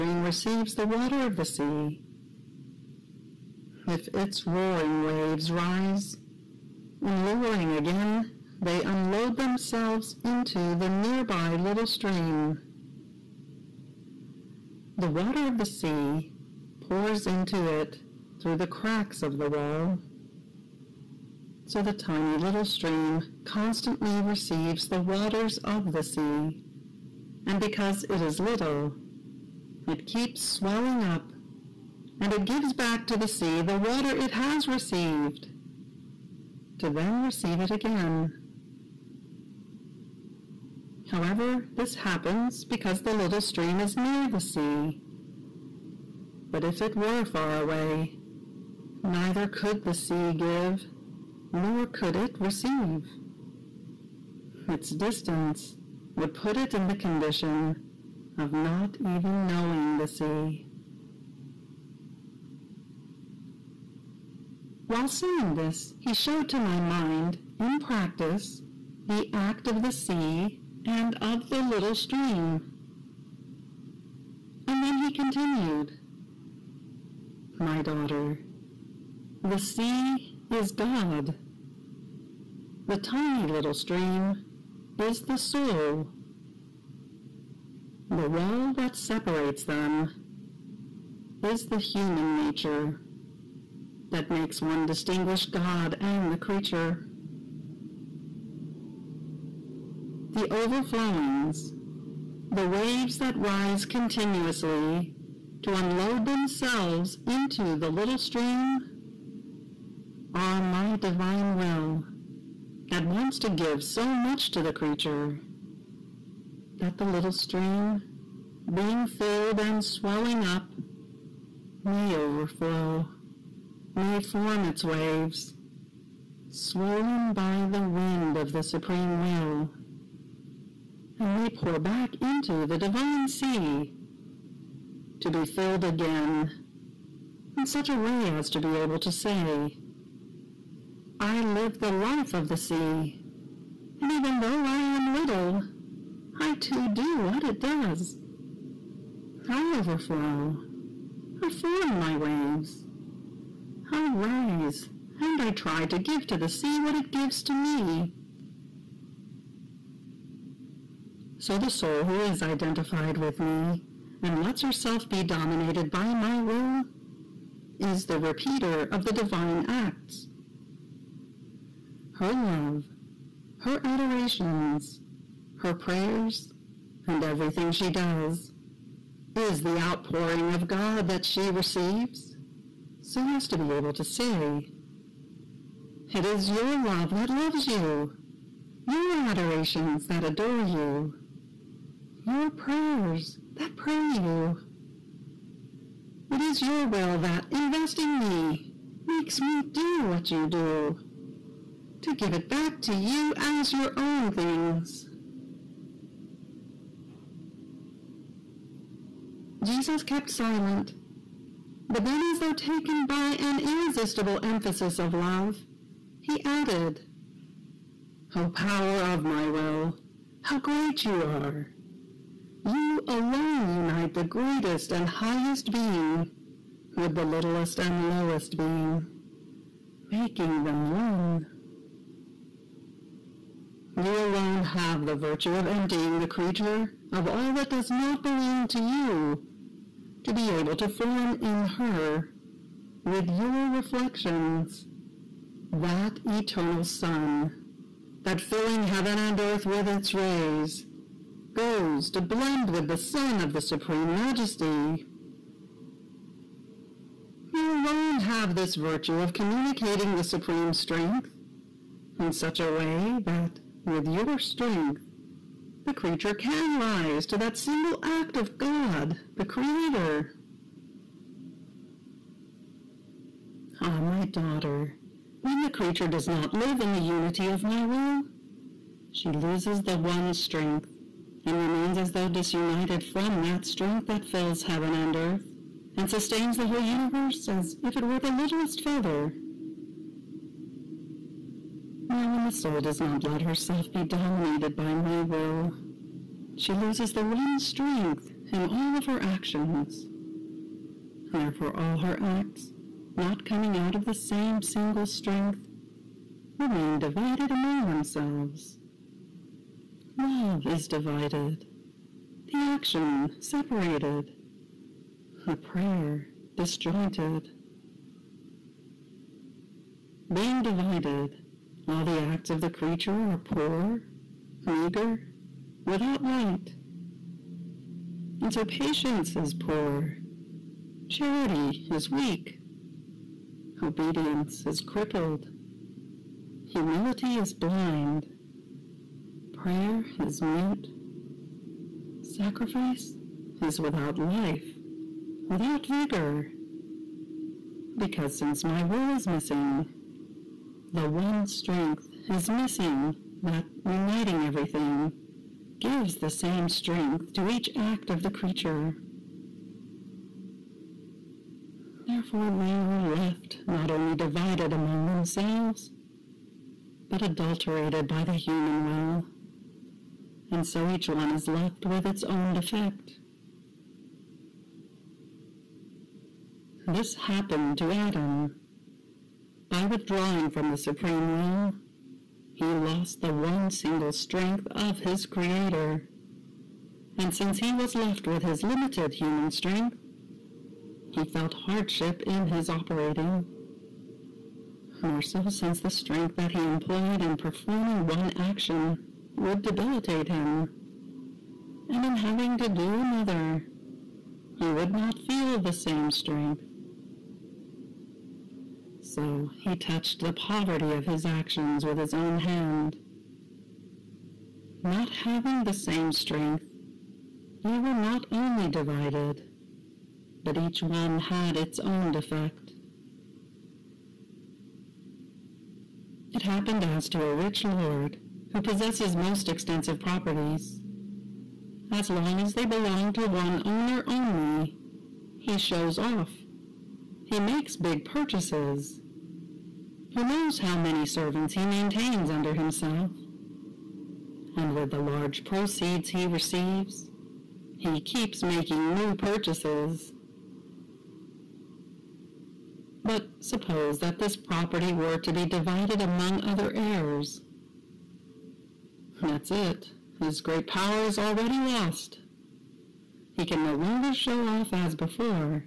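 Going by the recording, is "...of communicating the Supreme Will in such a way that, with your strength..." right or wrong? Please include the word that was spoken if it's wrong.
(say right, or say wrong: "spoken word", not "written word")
wrong: "Strength", not "Will".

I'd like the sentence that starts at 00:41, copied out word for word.
However, this happens because the little stream is near the sea.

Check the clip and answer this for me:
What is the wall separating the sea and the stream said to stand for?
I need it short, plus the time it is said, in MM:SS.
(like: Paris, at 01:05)
Human nature, at 01:31.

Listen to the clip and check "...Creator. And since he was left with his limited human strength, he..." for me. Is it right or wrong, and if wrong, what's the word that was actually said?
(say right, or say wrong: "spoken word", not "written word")
right.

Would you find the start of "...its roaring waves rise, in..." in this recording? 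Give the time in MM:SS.
00:04.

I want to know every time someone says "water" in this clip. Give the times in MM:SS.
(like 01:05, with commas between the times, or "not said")
00:00, 00:15, 00:24, 00:33.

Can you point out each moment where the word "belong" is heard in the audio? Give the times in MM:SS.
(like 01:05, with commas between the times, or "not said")
03:58, 07:12.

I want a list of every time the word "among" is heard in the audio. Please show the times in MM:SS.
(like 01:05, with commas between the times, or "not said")
05:07, 06:04, 07:35.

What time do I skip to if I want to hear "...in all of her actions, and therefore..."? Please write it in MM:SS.
04:58.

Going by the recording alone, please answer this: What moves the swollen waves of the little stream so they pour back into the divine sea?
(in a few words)
The wind of the Supreme Will.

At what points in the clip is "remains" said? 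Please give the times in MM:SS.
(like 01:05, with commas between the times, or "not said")
04:41, 05:06.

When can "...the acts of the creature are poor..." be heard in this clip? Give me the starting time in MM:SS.
05:22.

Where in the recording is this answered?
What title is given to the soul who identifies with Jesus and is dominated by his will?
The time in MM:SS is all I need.
02:48.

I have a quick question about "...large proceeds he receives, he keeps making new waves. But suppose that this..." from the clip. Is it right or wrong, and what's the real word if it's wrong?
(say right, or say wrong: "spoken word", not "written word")
wrong: "purchases", not "waves".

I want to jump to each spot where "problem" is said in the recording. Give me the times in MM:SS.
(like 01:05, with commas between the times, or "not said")
not said.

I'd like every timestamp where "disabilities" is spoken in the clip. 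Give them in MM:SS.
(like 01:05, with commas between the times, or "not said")
not said.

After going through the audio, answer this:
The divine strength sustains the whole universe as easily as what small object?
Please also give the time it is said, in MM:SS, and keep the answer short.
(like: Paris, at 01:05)
The littlest feather, at 04:48.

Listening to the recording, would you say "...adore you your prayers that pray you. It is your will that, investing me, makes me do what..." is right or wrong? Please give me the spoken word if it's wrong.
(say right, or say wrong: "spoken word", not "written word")
right.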